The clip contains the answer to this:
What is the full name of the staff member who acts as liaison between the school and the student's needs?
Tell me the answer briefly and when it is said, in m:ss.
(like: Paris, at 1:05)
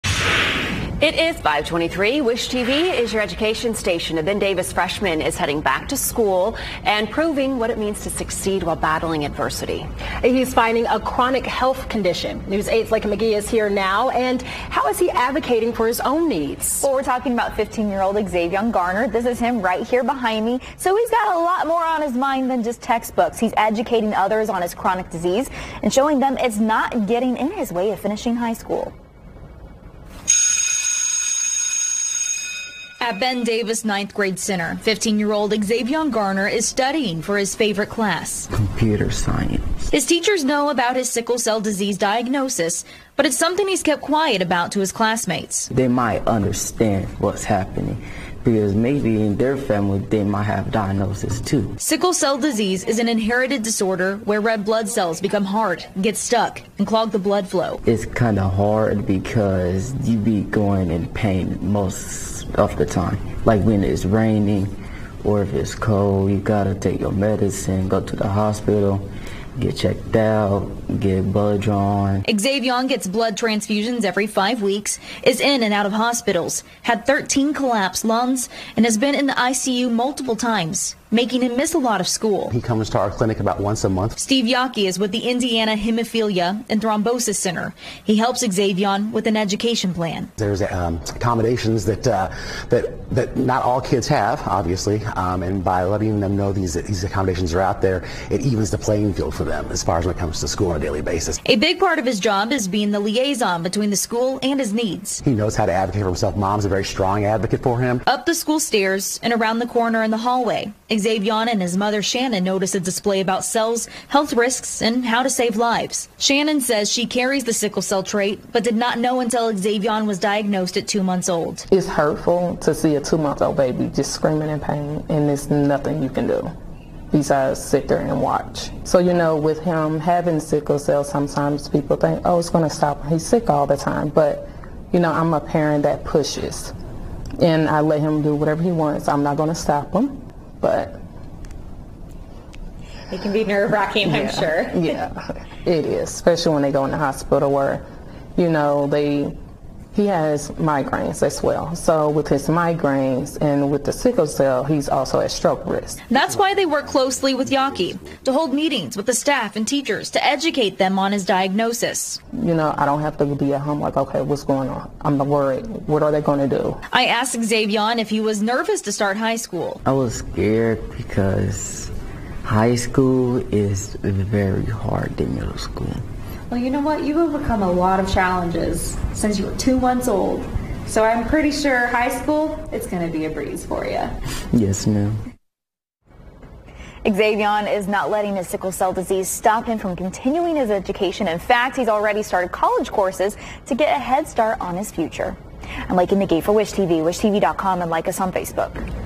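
Steve Yockey, at 1:24.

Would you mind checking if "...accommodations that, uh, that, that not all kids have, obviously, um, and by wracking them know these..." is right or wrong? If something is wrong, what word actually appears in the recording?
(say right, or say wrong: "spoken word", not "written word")
wrong: "letting", not "wracking".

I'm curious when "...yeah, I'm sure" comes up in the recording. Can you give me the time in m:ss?
2:24.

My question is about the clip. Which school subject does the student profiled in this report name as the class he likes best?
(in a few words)
computer science.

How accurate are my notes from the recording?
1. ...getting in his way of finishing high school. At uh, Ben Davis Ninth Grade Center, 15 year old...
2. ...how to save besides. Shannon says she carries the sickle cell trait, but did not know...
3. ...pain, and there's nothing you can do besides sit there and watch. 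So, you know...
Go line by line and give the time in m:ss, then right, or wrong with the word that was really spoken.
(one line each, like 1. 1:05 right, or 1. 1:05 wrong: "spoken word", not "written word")
1. 0:27 right
2. 1:55 wrong: "lives", not "besides"
3. 2:04 right.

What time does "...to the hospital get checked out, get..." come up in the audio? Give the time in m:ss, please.
1:08.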